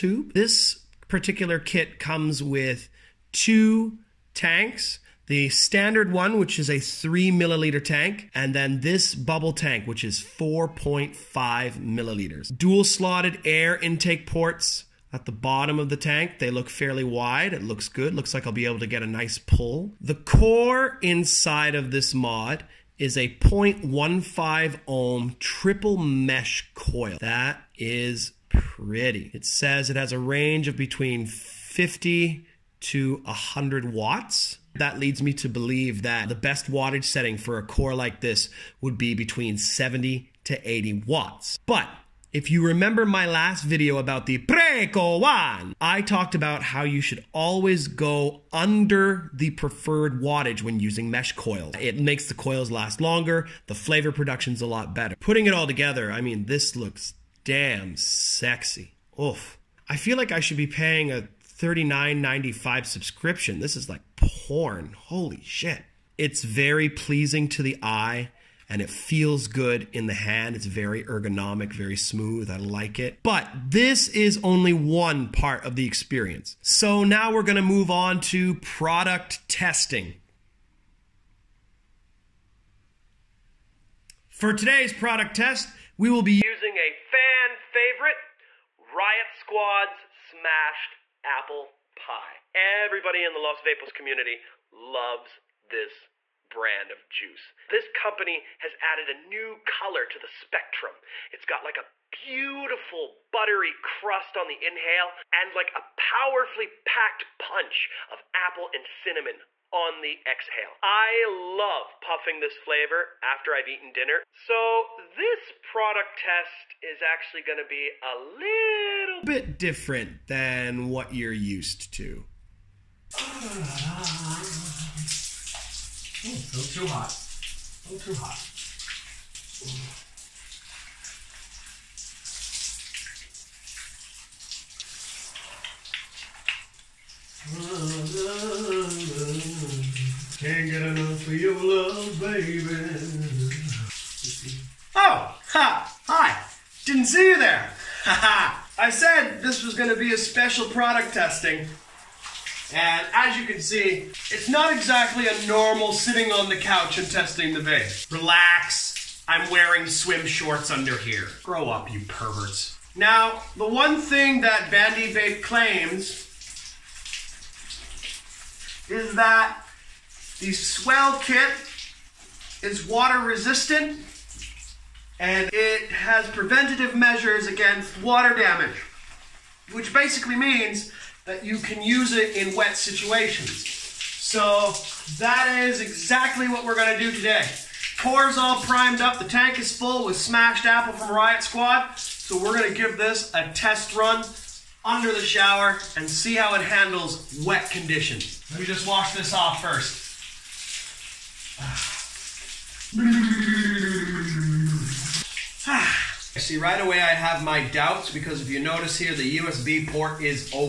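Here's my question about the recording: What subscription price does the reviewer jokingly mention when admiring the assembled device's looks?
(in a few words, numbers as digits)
$39.95.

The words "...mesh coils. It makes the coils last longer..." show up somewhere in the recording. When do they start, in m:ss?
0:51.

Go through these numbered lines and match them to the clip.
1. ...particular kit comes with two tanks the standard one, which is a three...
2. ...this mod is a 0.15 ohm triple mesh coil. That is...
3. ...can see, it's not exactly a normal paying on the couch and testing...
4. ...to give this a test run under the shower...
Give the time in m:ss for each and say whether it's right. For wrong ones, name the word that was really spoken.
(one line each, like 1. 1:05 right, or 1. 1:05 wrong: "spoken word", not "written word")
1. 0:01 right
2. 0:21 right
3. 2:33 wrong: "sitting", not "paying"
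4. 3:12 right.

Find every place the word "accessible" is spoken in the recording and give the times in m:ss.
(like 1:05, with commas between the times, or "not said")
not said.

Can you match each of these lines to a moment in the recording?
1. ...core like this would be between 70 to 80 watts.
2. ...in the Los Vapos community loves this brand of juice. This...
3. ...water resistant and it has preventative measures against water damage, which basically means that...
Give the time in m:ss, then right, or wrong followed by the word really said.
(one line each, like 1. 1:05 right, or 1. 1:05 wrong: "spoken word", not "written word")
1. 0:37 right
2. 1:33 right
3. 2:52 right.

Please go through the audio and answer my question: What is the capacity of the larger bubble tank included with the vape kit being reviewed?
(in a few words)
4.5 milliliters.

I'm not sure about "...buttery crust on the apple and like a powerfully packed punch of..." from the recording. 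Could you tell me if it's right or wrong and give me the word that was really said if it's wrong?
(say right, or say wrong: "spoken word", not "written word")
wrong: "inhale", not "apple".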